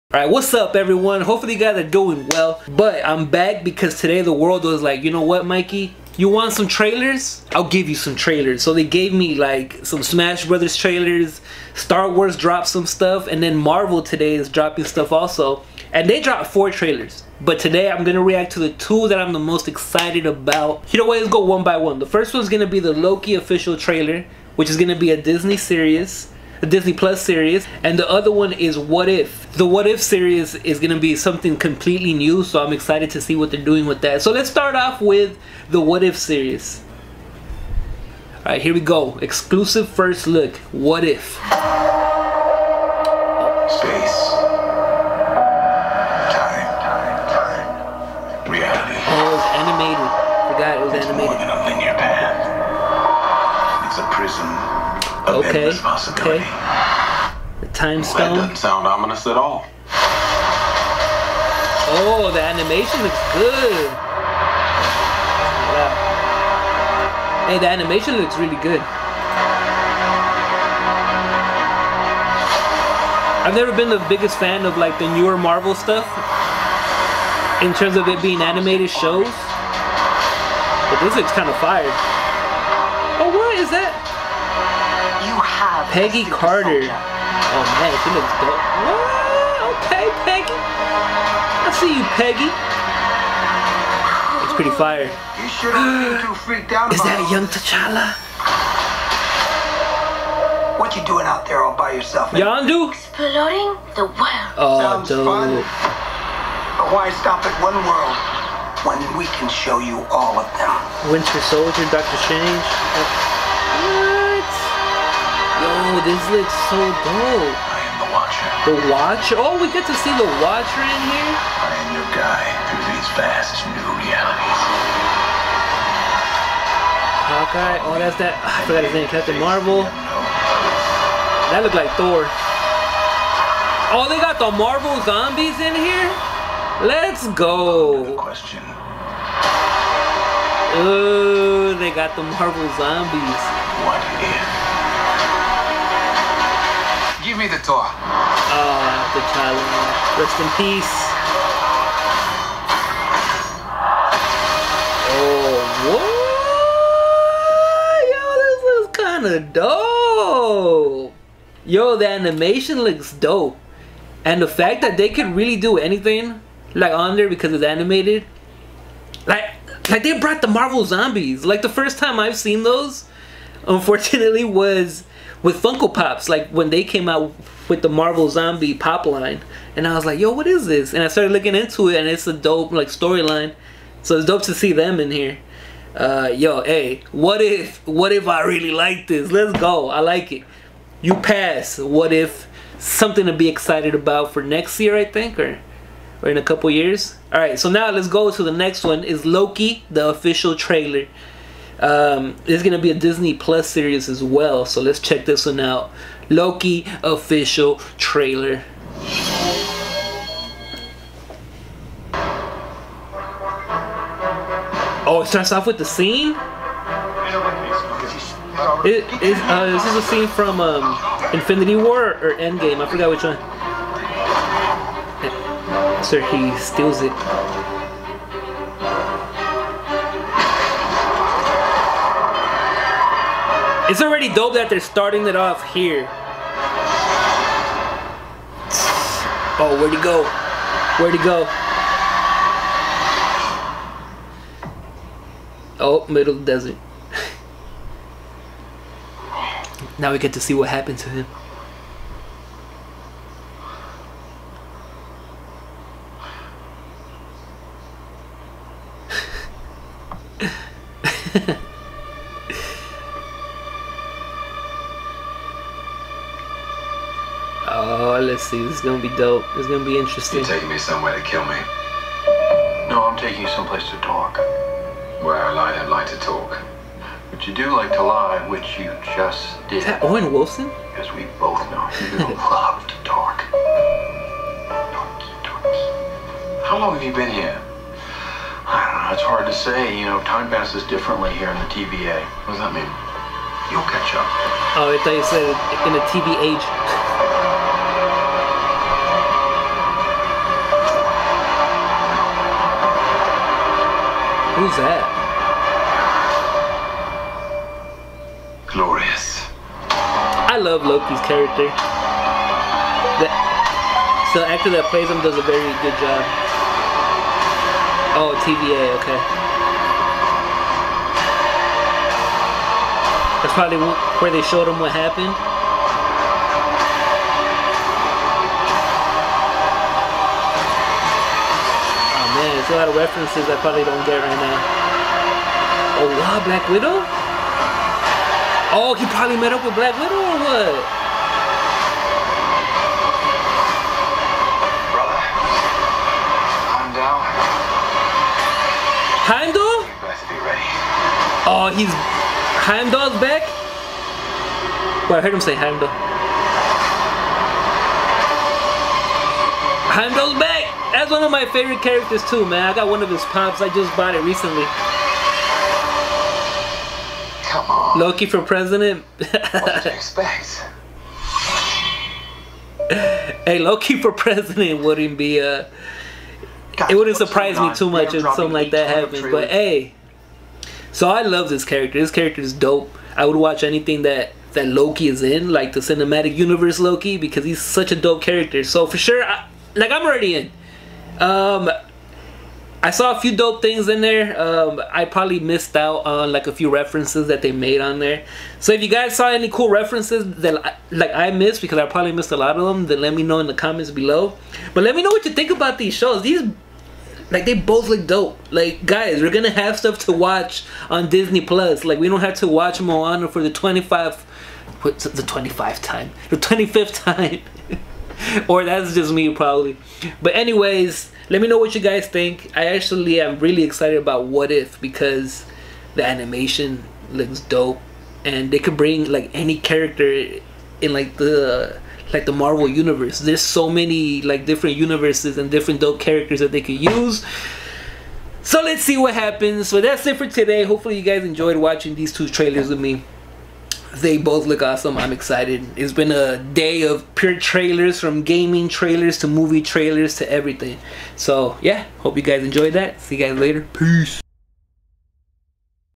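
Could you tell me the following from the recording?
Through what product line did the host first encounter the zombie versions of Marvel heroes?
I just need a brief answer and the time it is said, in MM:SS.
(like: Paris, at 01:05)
Funko Pops, at 02:55.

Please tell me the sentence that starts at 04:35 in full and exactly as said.
Where I lie, I don't like to talk.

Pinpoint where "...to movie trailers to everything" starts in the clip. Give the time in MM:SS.
07:29.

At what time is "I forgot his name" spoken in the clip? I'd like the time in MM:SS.
02:08.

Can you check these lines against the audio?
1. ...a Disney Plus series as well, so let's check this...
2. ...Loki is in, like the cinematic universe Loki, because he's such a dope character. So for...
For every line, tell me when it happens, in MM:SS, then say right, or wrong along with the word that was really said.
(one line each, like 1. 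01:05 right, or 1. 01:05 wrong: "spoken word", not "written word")
1. 03:22 right
2. 06:24 right.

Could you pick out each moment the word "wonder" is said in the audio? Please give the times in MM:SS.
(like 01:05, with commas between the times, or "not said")
not said.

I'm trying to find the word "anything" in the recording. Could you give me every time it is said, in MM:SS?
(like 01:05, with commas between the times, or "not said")
02:45, 06:23.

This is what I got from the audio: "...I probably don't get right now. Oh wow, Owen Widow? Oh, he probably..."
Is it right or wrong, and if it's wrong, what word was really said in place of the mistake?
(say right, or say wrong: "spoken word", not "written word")
wrong: "Black", not "Owen".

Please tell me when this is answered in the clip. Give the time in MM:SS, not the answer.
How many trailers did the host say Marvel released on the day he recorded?
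00:16.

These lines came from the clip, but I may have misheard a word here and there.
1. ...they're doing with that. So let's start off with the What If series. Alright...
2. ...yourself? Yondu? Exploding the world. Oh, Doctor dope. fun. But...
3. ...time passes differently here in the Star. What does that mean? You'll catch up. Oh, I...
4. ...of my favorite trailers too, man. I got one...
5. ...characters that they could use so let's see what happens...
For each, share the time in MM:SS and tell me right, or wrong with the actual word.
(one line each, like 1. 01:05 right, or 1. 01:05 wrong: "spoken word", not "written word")
1. 00:33 right
2. 01:41 wrong: "Sounds", not "Doctor"
3. 04:50 wrong: "TVA", not "Star"
4. 06:01 wrong: "characters", not "trailers"
5. 07:15 right.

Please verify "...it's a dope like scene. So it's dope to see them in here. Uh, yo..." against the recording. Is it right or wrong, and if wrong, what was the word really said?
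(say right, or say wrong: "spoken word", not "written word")
wrong: "storyline", not "scene".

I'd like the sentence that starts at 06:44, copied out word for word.
But let me know what you think about these shows.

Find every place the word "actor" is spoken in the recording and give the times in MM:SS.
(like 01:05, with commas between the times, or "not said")
05:14.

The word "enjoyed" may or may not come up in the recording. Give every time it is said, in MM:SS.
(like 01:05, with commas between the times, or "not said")
07:21, 07:32.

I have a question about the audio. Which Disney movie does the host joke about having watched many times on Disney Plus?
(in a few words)
Moana.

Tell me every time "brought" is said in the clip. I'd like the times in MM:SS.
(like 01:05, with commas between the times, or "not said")
02:50.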